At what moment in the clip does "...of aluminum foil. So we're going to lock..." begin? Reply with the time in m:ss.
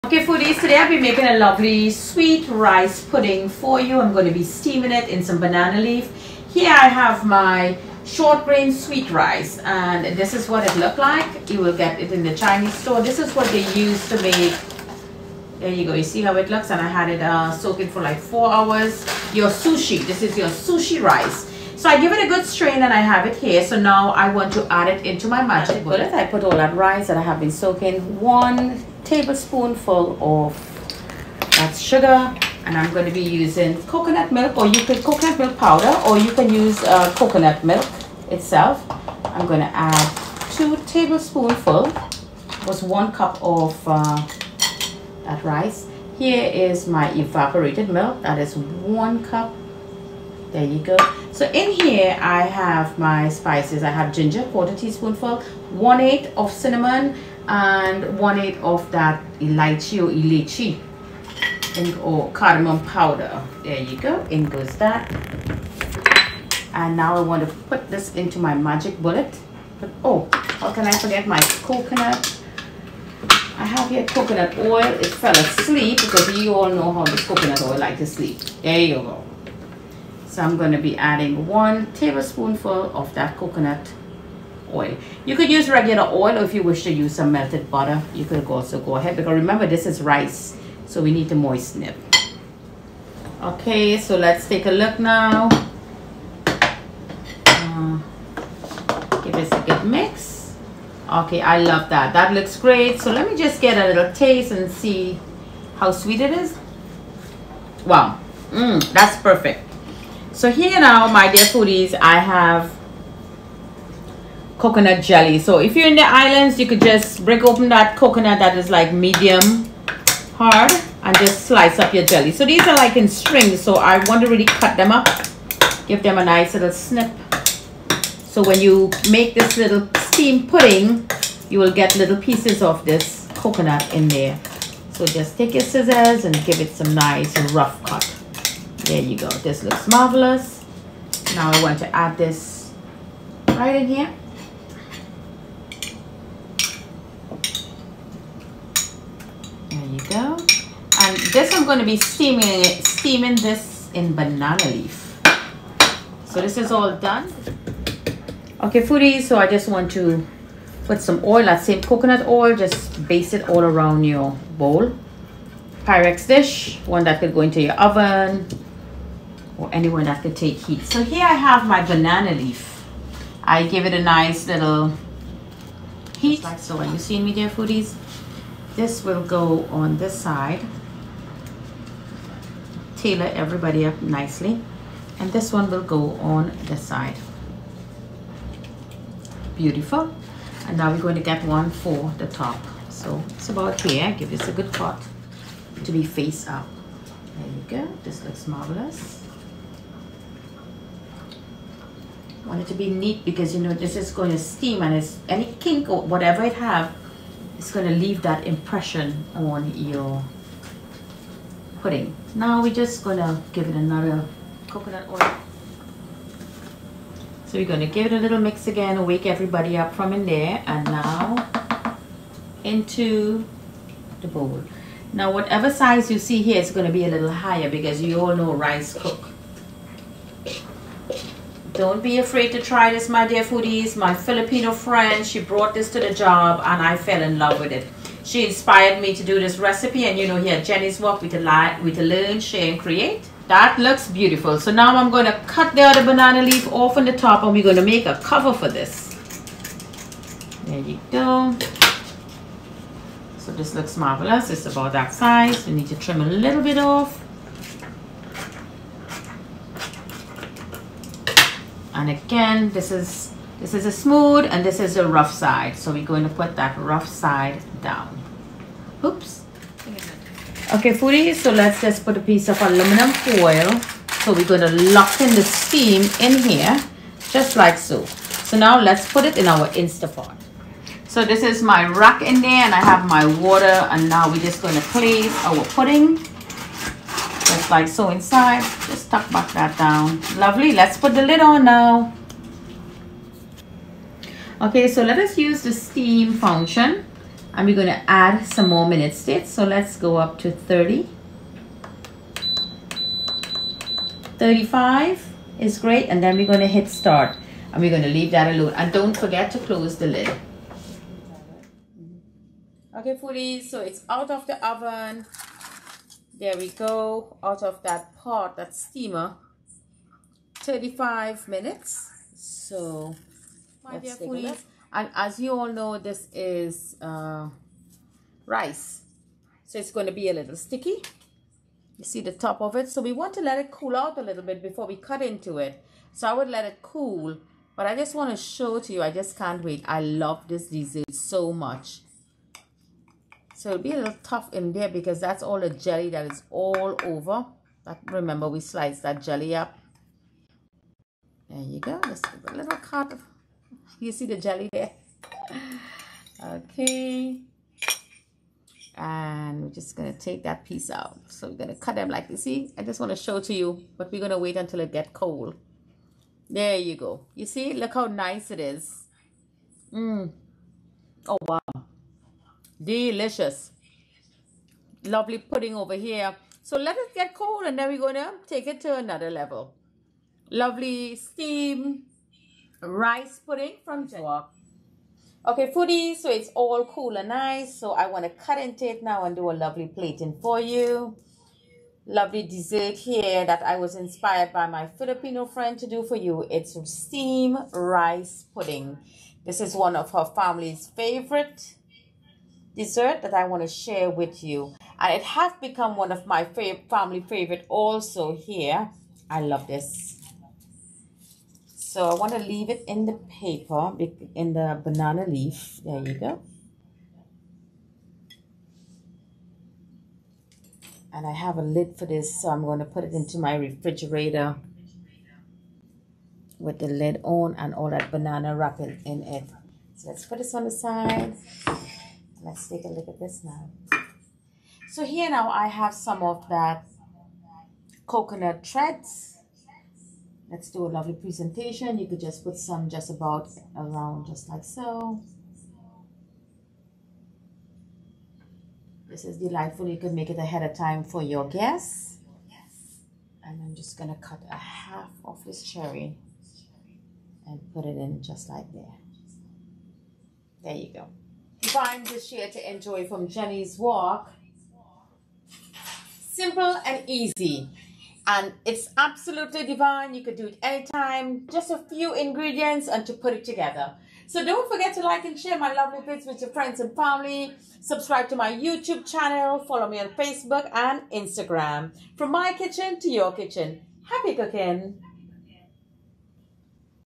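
4:32.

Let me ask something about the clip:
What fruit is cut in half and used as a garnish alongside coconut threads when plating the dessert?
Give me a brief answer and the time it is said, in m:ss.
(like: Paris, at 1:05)
cherry, at 7:35.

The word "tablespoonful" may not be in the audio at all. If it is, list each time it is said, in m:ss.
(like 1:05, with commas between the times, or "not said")
0:29, 0:40, 1:21.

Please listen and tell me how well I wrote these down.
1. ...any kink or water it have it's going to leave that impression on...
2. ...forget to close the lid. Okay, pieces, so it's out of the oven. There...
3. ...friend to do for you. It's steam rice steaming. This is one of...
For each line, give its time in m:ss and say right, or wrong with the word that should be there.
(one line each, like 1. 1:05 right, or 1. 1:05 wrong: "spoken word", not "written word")
1. 3:25 wrong: "whatever", not "water"
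2. 5:09 wrong: "foodies", not "pieces"
3. 6:35 wrong: "pudding", not "steaming".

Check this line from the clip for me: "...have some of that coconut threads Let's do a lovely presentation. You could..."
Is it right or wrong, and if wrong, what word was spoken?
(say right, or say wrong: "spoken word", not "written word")
right.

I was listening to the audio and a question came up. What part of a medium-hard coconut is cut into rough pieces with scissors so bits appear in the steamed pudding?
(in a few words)
coconut jelly.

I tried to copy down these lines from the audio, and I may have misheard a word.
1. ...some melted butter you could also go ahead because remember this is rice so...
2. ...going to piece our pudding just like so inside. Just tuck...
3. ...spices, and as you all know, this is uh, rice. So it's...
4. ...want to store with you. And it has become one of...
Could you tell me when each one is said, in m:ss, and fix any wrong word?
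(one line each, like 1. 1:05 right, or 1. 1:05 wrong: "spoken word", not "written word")
1. 1:27 right
2. 4:44 wrong: "place", not "piece"
3. 5:24 wrong: "foodies", not "spices"
4. 6:43 wrong: "share", not "store".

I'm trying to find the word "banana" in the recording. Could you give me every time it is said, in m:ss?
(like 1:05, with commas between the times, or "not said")
0:05, 2:34, 2:51, 4:06, 6:54, 7:08.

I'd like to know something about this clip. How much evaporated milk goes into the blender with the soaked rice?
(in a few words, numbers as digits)
1 cup.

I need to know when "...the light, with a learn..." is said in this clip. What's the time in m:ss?
4:01.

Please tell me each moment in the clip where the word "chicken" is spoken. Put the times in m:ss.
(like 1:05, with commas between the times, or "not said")
not said.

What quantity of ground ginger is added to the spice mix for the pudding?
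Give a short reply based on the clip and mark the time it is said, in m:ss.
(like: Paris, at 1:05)
1/4 teaspoon, at 0:54.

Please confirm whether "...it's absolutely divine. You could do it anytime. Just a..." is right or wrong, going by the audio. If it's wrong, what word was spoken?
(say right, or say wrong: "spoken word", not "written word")
right.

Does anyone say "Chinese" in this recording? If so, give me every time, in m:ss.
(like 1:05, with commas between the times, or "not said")
0:12.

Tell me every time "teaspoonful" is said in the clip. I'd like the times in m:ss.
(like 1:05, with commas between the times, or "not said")
0:54.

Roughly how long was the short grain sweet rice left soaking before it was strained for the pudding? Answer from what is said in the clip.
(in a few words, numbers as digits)
4 hours.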